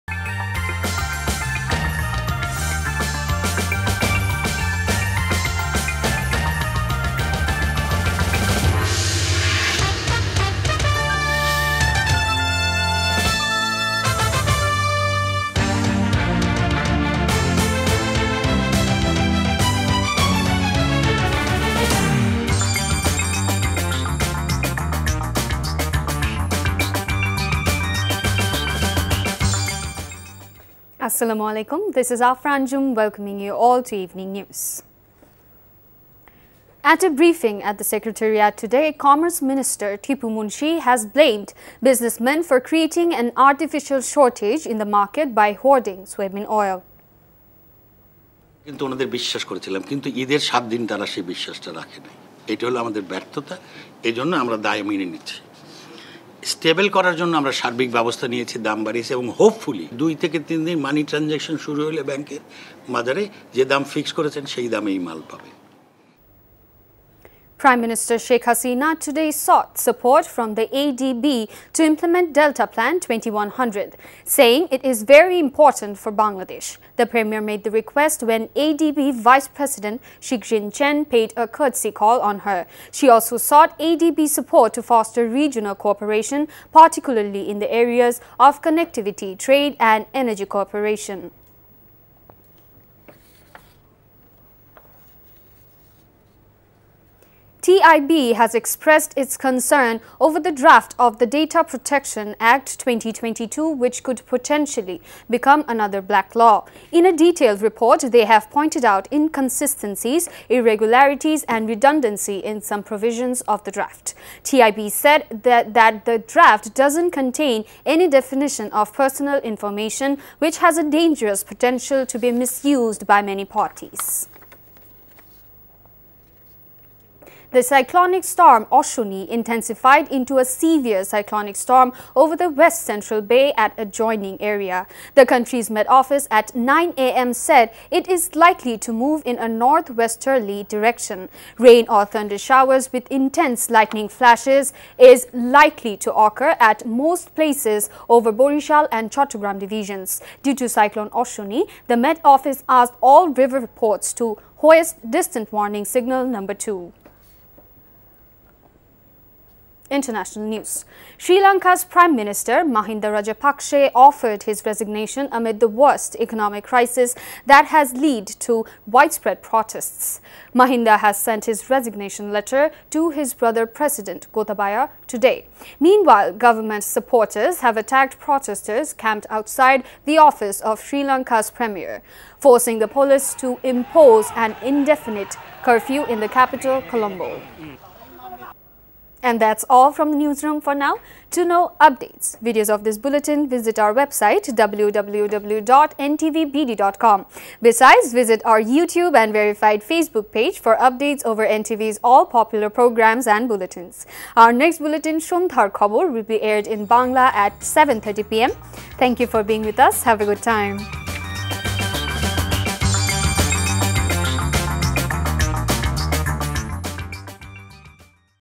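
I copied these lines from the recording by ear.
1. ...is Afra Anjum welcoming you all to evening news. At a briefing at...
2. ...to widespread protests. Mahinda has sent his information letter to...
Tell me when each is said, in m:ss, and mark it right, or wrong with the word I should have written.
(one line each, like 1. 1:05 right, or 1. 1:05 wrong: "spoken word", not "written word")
1. 0:32 right
2. 2:48 wrong: "resignation", not "information".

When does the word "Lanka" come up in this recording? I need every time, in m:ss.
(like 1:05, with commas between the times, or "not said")
2:41, 3:01.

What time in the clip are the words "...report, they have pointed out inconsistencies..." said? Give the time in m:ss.
1:47.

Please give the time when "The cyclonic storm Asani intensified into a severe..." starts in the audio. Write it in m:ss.
2:07.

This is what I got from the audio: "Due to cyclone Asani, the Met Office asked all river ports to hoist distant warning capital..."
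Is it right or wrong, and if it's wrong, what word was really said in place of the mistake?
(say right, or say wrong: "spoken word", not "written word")
wrong: "signal", not "capital".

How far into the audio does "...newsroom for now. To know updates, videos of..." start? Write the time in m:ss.
3:10.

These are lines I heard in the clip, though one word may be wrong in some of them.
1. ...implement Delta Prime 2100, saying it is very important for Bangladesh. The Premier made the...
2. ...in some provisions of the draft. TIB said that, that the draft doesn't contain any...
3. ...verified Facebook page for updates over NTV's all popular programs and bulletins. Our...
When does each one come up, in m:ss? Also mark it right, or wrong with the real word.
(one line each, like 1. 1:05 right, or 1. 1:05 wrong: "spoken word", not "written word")
1. 1:11 wrong: "Plan", not "Prime"
2. 1:52 right
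3. 3:19 right.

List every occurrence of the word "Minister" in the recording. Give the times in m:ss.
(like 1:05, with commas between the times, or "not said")
0:39, 1:07, 2:42.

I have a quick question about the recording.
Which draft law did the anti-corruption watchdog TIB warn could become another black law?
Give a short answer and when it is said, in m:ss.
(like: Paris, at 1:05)
Data Protection Act 2022, at 1:41.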